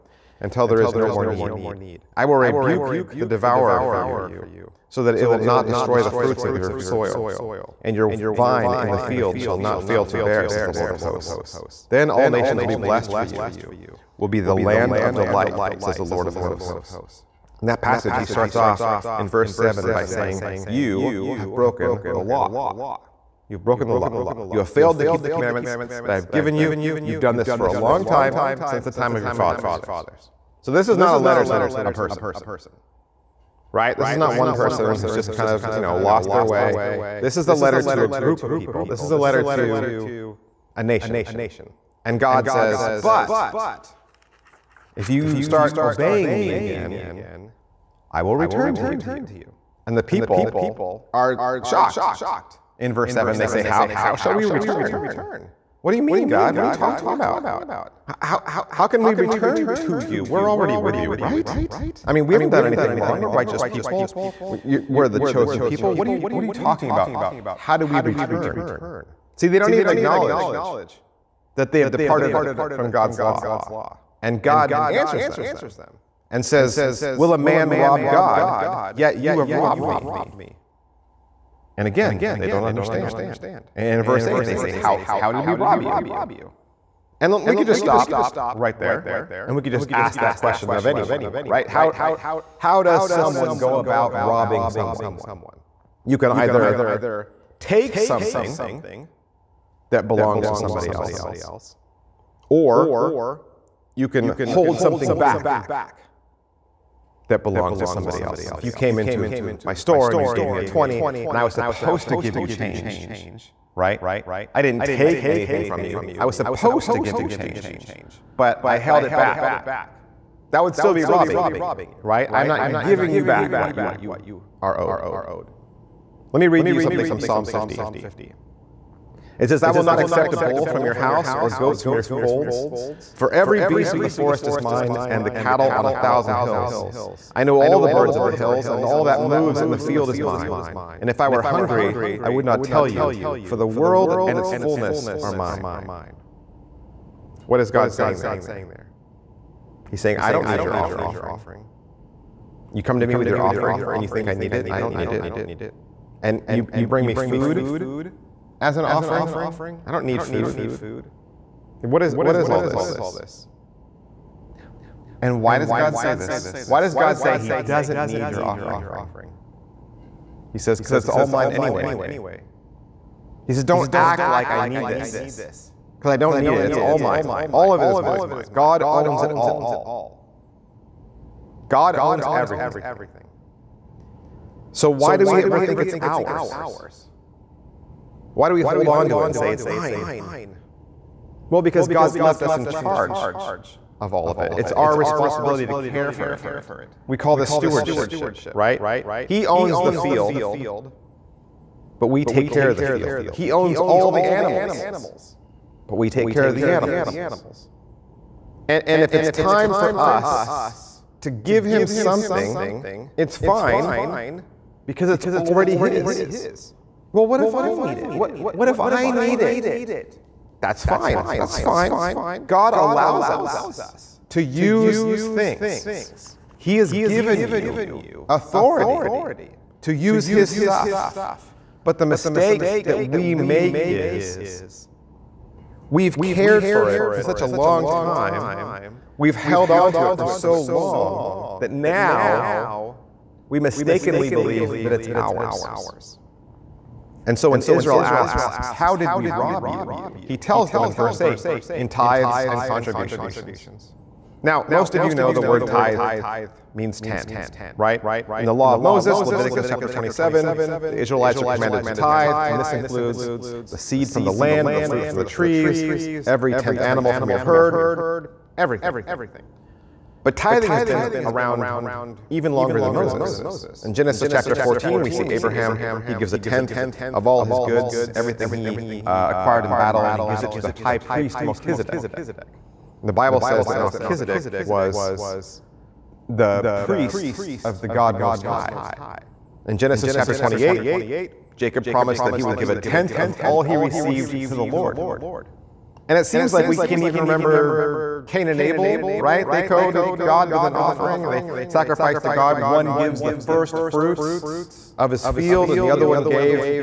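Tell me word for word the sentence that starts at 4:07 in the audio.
And so when Israel asks, How did we rob you?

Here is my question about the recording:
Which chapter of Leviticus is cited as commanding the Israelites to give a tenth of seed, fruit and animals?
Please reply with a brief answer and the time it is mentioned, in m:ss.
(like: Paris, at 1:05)
Chapter 27, at 4:19.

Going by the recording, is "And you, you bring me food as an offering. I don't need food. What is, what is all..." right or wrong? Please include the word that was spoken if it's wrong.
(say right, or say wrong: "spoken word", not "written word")
right.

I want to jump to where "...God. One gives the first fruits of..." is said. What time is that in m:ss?
5:02.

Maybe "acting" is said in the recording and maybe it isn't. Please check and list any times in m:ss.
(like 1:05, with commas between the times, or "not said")
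not said.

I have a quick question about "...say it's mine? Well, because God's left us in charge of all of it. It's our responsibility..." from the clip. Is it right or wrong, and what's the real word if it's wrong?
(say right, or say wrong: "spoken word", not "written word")
right.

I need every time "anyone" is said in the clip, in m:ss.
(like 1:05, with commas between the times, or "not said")
1:30.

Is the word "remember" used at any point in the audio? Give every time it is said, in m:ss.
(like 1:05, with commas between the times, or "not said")
4:57.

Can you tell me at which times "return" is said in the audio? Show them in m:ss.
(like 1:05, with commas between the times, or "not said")
0:48, 0:54, 0:59, 1:07.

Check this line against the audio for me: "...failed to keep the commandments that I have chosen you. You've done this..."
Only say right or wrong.
wrong.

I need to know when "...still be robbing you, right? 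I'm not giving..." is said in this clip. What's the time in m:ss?
2:00.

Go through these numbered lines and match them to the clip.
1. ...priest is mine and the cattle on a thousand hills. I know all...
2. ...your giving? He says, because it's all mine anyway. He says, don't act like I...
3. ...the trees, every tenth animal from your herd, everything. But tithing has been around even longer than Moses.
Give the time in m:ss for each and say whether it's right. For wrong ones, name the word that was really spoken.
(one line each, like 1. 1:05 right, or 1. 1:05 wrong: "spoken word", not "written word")
1. 2:14 wrong: "forest", not "priest"
2. 2:48 wrong: "offering", not "giving"
3. 4:25 right.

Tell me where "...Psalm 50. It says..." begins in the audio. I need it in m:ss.
2:07.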